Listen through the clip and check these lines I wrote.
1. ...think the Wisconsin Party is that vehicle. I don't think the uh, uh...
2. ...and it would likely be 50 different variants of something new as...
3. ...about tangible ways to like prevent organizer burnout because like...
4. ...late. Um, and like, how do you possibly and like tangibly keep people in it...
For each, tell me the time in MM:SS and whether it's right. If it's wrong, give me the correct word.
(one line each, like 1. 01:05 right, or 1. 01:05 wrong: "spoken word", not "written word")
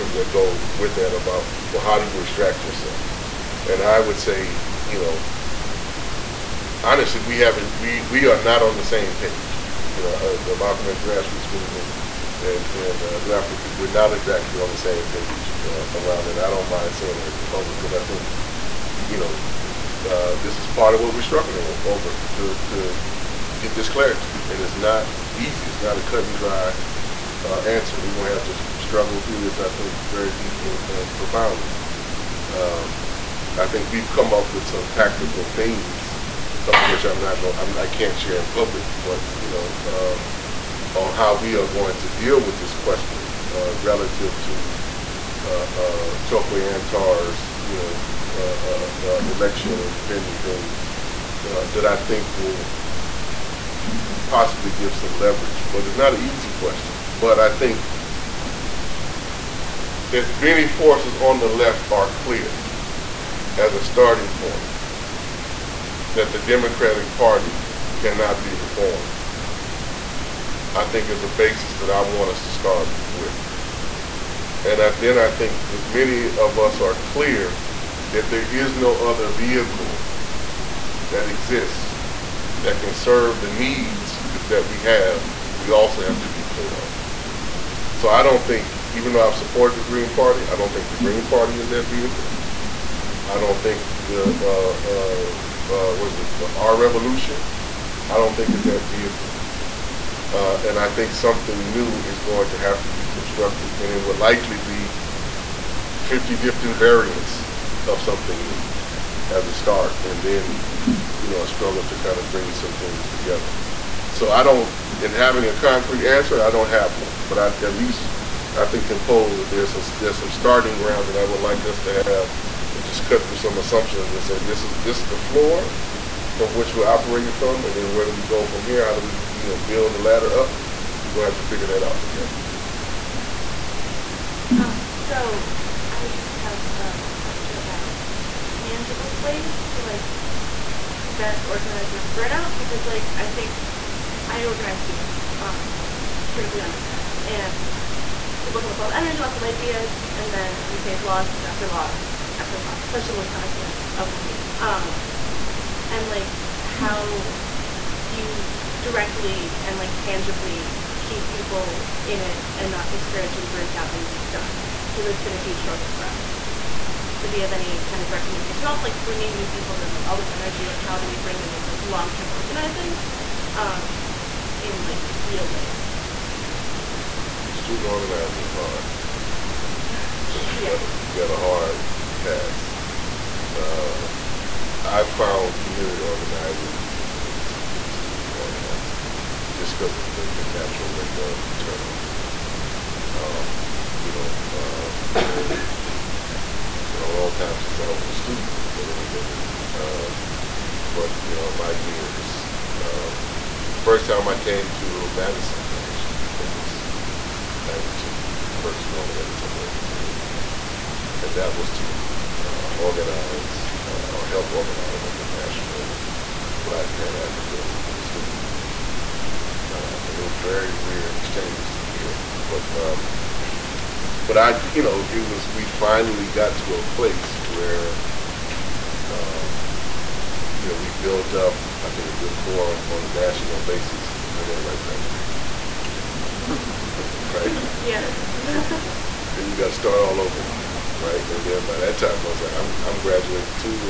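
1. 01:30 wrong: "Green", not "Wisconsin"
2. 01:43 right
3. 02:17 right
4. 02:34 wrong: "directly", not "possibly".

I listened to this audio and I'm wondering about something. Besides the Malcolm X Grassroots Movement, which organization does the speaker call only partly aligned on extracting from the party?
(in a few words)
New African People.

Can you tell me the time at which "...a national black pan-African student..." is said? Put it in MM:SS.
03:35.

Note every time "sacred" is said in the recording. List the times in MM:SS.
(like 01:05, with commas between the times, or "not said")
not said.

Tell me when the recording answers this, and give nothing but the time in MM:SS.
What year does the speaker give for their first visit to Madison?
03:27.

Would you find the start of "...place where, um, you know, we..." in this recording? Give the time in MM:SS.
03:46.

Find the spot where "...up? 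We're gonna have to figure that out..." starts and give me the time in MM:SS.
02:10.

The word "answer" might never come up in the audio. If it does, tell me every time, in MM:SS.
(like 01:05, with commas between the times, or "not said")
00:27, 01:56.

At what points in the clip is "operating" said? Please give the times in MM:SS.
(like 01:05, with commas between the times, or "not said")
02:06.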